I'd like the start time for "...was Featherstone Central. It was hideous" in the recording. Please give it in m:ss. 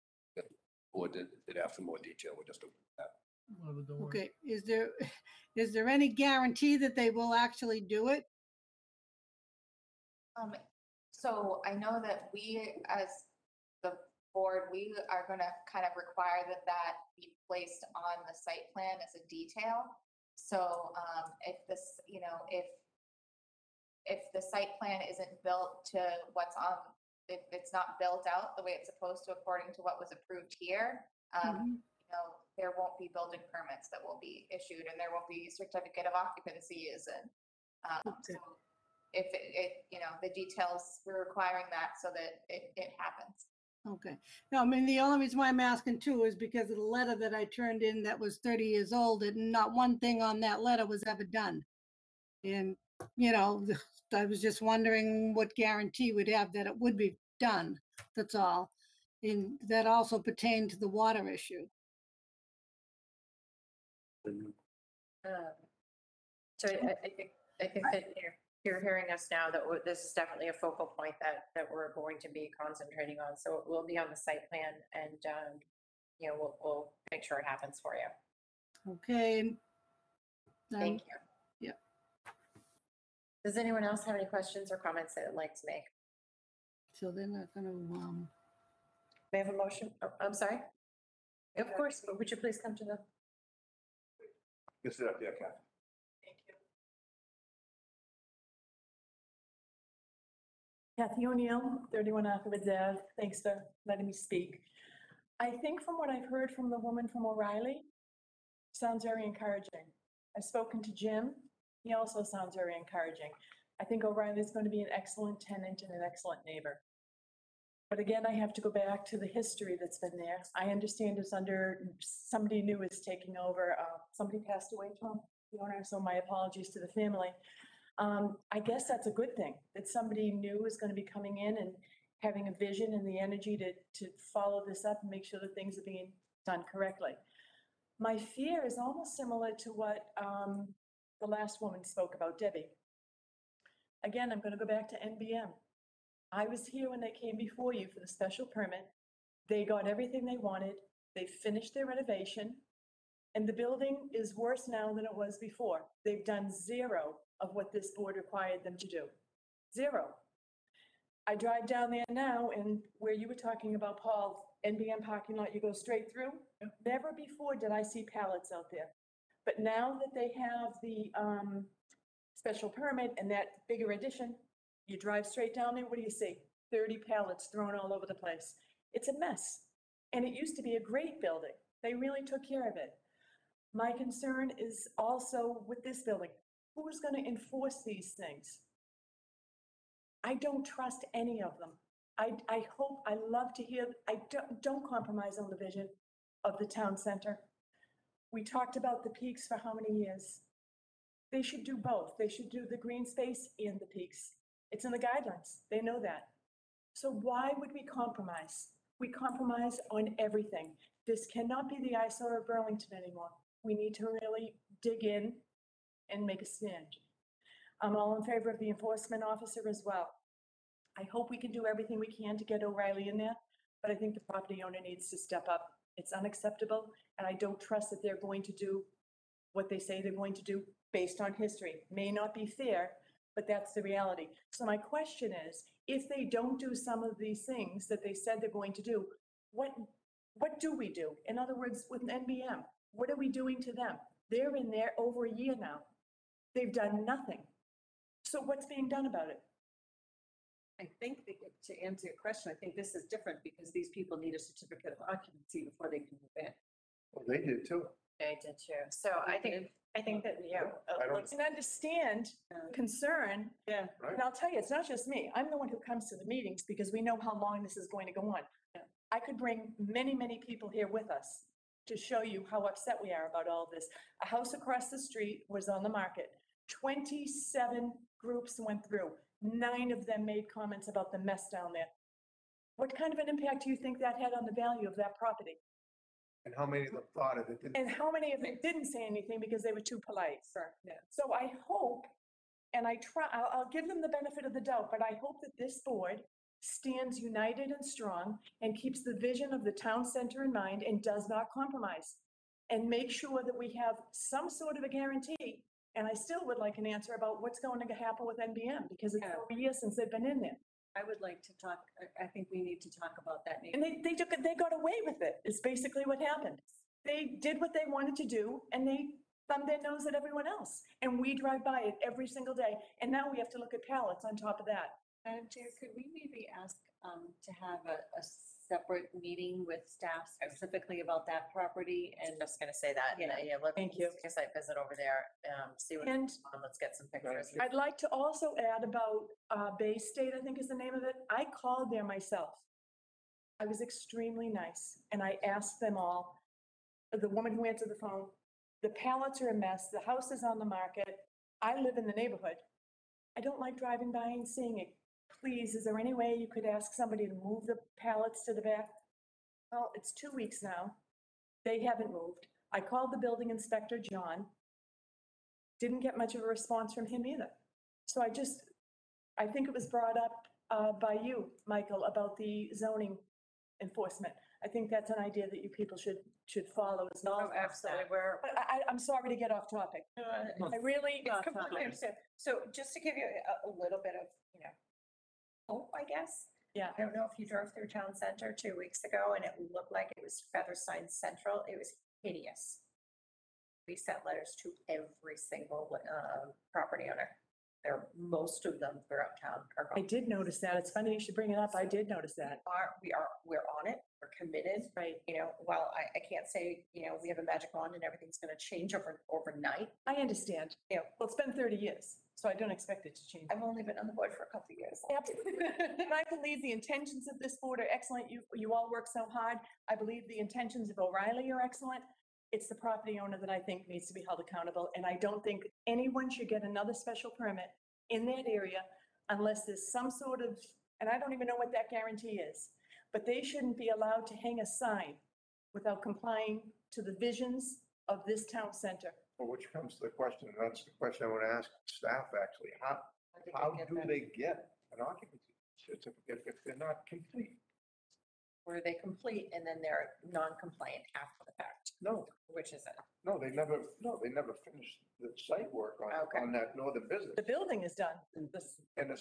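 6:30.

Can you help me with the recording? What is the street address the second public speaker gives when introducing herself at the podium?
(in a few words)
31 Aquabid Ave.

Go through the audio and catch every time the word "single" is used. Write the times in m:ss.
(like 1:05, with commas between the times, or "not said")
5:22, 6:35.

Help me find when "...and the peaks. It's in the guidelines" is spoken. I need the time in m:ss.
3:23.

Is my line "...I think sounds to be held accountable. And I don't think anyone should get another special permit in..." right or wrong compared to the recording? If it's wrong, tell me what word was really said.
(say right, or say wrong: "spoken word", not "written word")
wrong: "needs", not "sounds".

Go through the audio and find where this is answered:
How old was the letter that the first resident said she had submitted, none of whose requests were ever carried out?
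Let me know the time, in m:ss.
0:48.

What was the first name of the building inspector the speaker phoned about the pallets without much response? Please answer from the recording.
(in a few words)
John.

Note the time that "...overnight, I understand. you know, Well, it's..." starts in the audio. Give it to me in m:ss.
6:49.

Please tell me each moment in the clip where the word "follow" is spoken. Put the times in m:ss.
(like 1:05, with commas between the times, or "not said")
2:14, 6:16.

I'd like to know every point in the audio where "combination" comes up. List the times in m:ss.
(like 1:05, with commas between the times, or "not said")
not said.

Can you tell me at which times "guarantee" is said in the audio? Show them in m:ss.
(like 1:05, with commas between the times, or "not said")
0:06, 0:55, 5:04, 7:11.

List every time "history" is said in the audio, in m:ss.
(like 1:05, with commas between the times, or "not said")
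1:59, 3:51.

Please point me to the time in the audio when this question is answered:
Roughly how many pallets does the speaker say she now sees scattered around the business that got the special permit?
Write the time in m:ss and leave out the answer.
2:56.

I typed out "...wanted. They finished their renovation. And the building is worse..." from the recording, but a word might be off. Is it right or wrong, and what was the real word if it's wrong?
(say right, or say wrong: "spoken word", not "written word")
right.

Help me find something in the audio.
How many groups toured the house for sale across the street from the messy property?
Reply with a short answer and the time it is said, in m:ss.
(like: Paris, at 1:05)
27, at 4:36.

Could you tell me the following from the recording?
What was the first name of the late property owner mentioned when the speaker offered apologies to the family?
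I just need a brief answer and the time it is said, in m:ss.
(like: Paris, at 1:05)
Tom, at 2:05.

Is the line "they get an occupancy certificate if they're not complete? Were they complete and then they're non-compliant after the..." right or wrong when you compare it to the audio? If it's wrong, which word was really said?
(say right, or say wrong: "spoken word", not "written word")
right.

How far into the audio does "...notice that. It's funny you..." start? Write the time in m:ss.
6:40.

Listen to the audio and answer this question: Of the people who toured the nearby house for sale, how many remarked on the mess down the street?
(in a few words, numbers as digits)
9.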